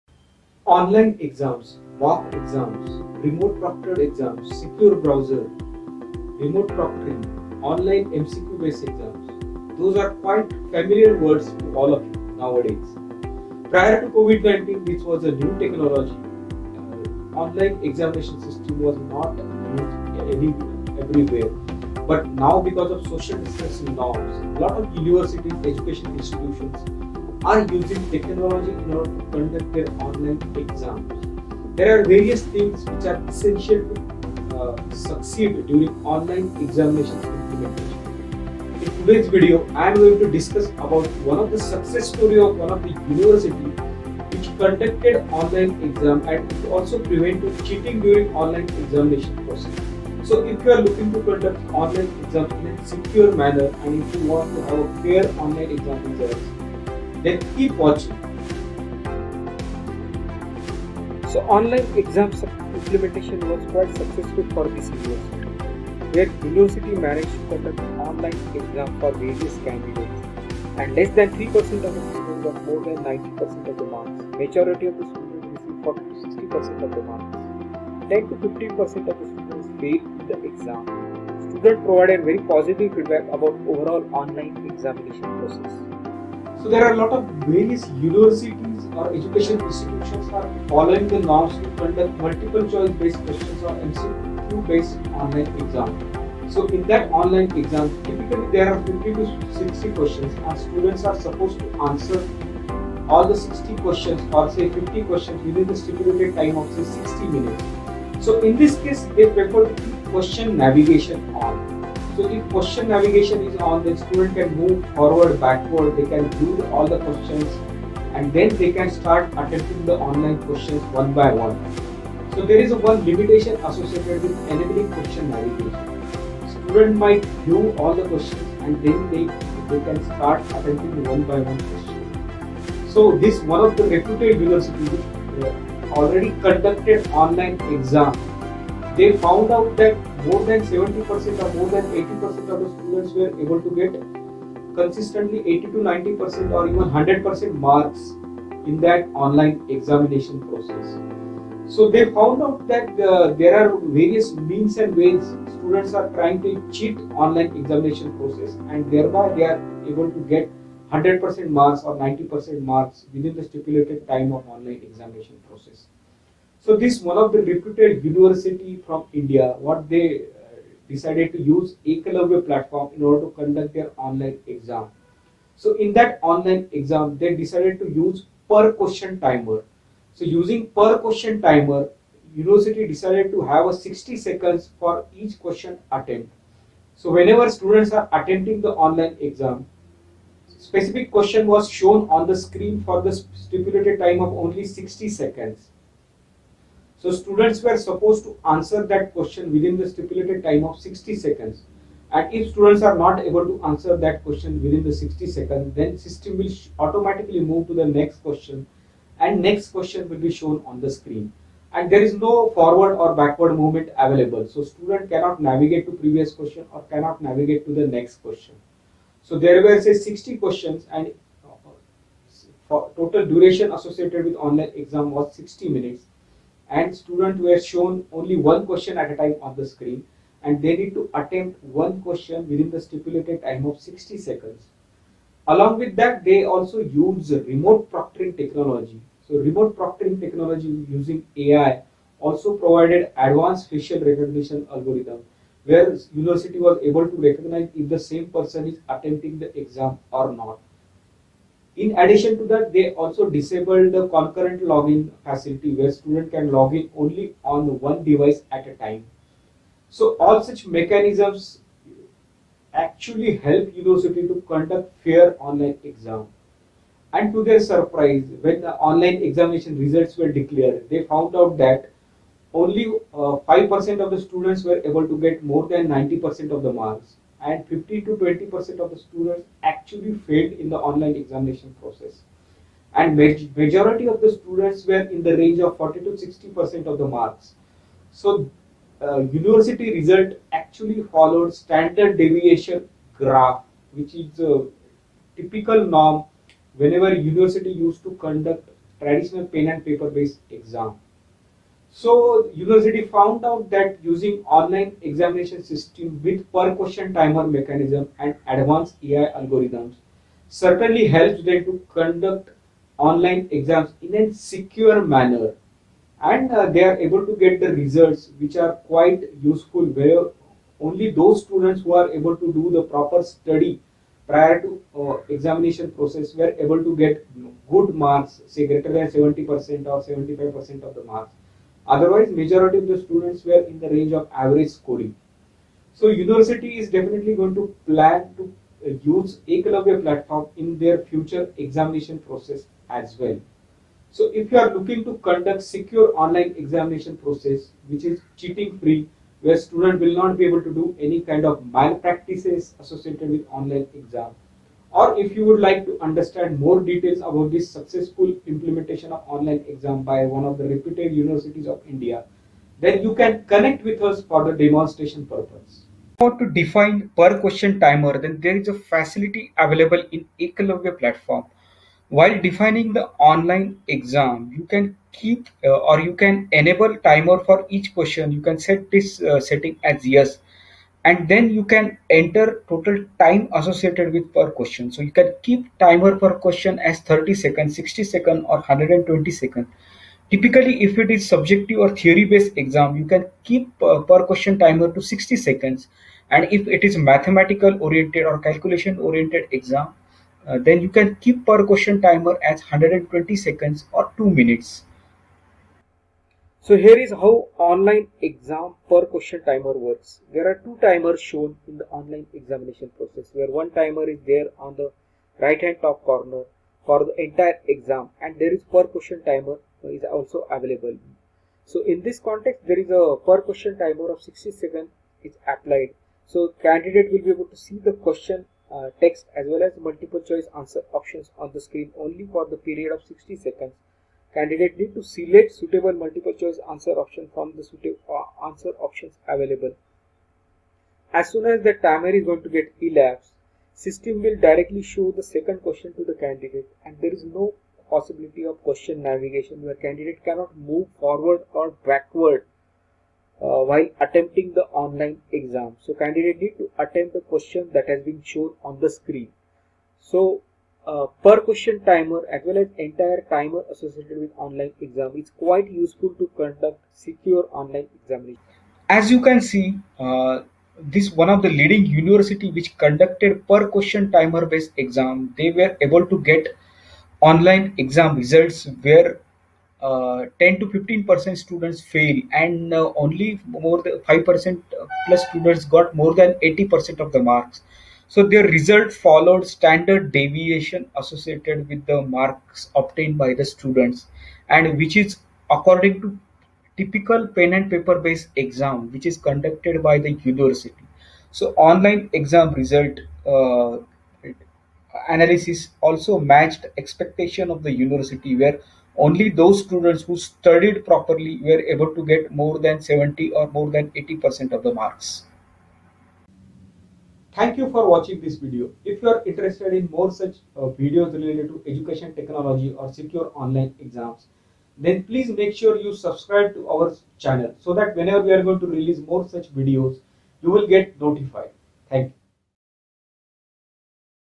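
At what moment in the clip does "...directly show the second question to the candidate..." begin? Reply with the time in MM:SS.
07:24.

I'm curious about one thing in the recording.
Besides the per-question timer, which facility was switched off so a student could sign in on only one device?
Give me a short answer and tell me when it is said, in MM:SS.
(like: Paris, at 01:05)
concurrent login, at 04:14.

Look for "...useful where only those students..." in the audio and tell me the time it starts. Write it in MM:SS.
05:19.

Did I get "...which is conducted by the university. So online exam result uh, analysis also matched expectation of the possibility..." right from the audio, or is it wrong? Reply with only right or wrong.
wrong.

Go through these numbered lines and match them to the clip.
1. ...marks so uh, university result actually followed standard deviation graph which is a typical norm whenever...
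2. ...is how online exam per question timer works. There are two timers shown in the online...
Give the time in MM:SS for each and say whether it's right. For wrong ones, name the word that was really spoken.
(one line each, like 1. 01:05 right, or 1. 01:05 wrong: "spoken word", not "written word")
1. 04:47 right
2. 06:46 right.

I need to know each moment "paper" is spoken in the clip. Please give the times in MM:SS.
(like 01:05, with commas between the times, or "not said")
04:59, 08:17.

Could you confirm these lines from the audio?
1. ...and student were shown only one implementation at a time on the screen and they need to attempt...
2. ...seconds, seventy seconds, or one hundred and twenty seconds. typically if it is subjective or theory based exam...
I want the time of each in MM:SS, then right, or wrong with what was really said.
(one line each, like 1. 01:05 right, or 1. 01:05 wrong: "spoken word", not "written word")
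1. 03:46 wrong: "question", not "implementation"
2. 06:27 wrong: "sixty", not "seventy".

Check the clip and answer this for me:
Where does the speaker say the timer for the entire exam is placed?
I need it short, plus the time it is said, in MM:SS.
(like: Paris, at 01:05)
right hand top corner, at 06:55.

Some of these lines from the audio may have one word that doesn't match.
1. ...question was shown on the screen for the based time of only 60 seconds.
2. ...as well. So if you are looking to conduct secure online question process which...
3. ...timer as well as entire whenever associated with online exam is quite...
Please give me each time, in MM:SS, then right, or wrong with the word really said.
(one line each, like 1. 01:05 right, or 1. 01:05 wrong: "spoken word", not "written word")
1. 03:11 wrong: "stipulated", not "based"
2. 05:42 wrong: "examination", not "question"
3. 07:41 wrong: "timer", not "whenever".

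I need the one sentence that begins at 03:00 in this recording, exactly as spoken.
So using per question timer, university decided to have a 60 seconds for each question attempt.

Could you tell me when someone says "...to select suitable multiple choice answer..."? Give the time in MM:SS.
07:14.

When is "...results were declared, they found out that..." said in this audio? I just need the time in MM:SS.
04:29.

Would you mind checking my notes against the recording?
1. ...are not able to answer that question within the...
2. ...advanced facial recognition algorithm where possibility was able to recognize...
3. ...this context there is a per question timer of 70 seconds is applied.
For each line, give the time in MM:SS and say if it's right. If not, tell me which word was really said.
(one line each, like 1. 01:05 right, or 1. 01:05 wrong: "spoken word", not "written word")
1. 03:22 right
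2. 04:03 wrong: "university", not "possibility"
3. 07:02 wrong: "60", not "70".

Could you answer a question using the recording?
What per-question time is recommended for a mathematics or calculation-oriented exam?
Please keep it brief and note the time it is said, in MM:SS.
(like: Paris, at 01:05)
120 seconds, at 06:42.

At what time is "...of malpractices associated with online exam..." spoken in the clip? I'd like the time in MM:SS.
05:51.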